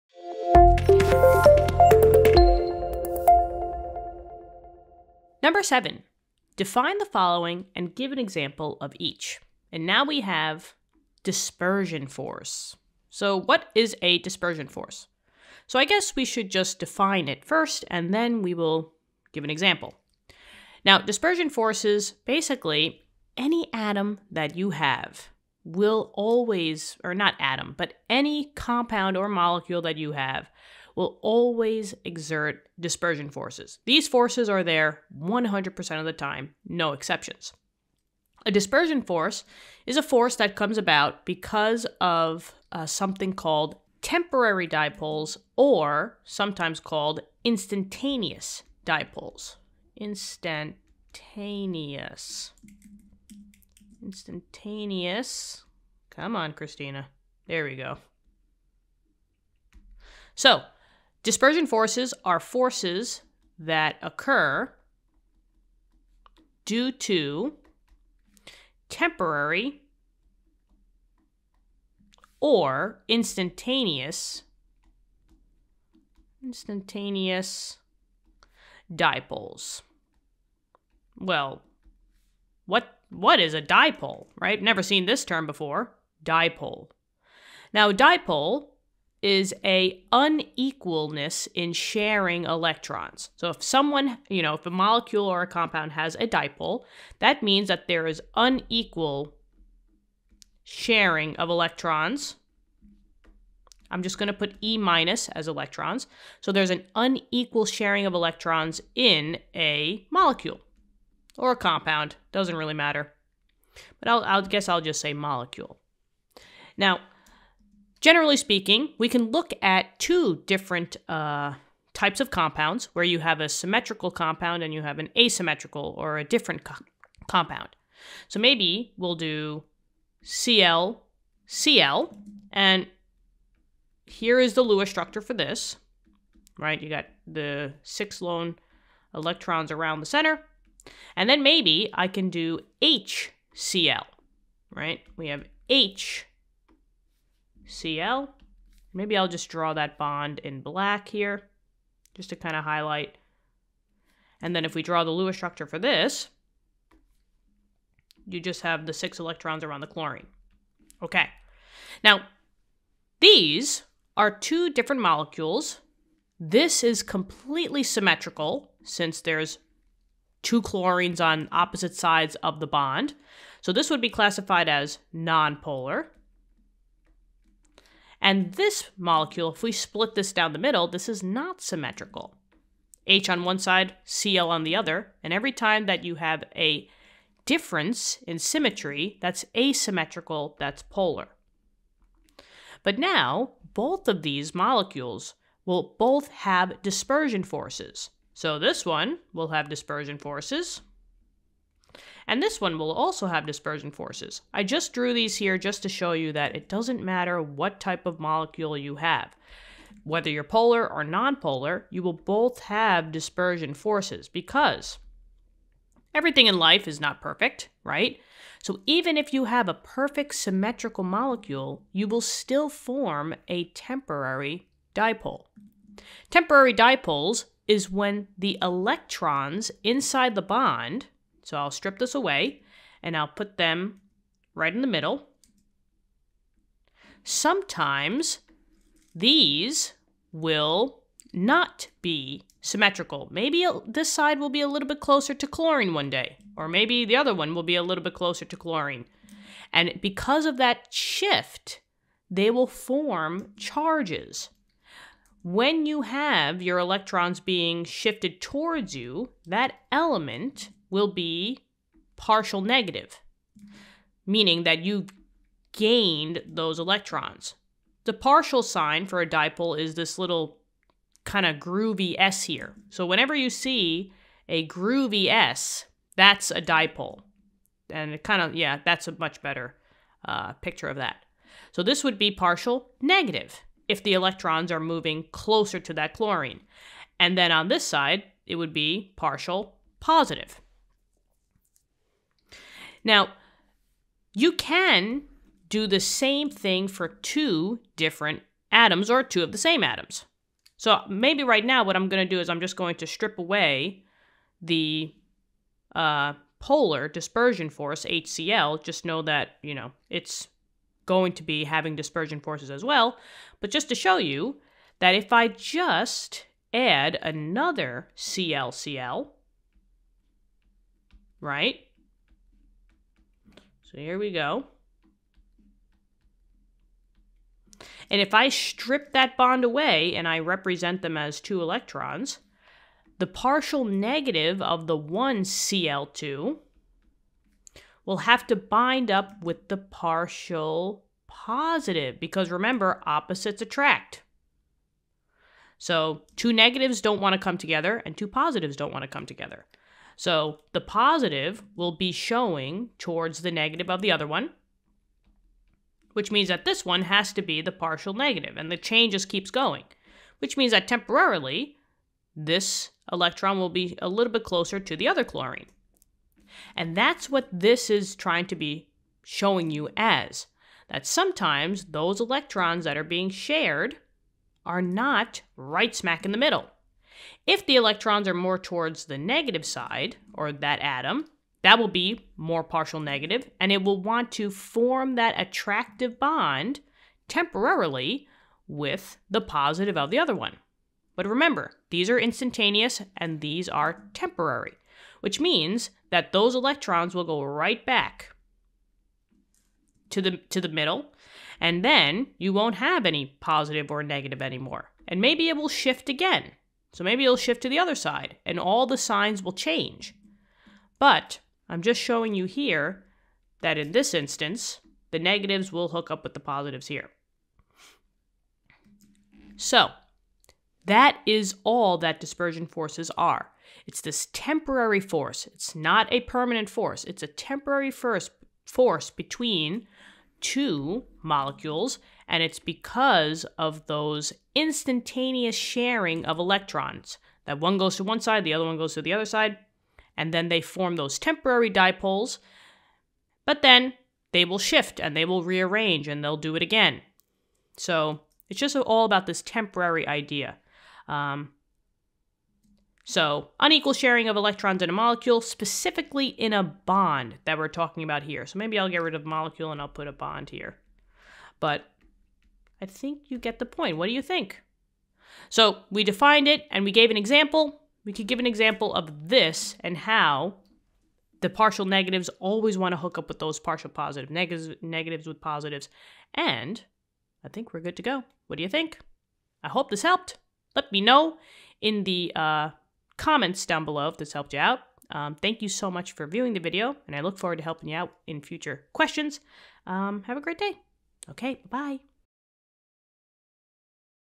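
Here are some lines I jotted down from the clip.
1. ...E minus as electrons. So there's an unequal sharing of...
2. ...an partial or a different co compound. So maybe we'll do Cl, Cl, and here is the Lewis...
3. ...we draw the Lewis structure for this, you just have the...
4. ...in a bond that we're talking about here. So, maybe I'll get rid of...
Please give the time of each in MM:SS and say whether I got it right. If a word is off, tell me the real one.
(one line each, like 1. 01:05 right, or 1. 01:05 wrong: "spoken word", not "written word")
1. 01:44 right
2. 02:04 wrong: "asymmetrical", not "partial"
3. 02:34 right
4. 07:36 right.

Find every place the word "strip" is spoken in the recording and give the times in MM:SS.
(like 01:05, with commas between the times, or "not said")
03:51, 05:03, 05:28.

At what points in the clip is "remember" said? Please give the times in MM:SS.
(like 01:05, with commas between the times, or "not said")
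05:42, 06:31.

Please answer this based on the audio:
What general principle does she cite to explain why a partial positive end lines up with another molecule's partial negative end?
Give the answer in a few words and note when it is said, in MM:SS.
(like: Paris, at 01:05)
Opposites attract, at 05:43.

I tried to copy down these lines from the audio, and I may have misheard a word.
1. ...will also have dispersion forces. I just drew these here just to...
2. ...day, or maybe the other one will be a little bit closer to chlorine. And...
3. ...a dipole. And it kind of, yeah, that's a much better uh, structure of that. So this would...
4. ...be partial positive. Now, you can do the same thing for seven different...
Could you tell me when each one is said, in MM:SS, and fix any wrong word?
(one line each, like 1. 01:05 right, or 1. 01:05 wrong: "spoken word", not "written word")
1. 03:22 right
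2. 04:06 right
3. 04:36 wrong: "picture", not "structure"
4. 04:48 wrong: "two", not "seven".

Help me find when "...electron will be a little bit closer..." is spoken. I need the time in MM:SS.
06:03.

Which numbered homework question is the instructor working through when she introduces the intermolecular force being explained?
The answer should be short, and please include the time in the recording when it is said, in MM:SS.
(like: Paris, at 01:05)
7, at 00:05.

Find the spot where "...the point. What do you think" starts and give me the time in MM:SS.
07:43.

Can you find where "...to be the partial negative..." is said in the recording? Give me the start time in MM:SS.
05:57.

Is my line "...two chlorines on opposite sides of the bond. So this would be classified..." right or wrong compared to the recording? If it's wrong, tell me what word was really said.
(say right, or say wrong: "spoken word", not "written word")
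right.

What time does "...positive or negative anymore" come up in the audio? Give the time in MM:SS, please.
06:43.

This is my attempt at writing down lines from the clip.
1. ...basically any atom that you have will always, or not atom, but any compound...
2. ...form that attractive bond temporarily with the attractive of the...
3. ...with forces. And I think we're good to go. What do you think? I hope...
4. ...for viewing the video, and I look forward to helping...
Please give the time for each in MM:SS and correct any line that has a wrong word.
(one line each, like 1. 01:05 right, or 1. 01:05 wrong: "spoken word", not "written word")
1. 00:22 right
2. 06:24 wrong: "positive", not "attractive"
3. 07:55 wrong: "positives", not "forces"
4. 08:06 right.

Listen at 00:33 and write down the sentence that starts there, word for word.
These forces are there 100% of the time, no exceptions.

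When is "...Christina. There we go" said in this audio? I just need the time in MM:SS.
00:56.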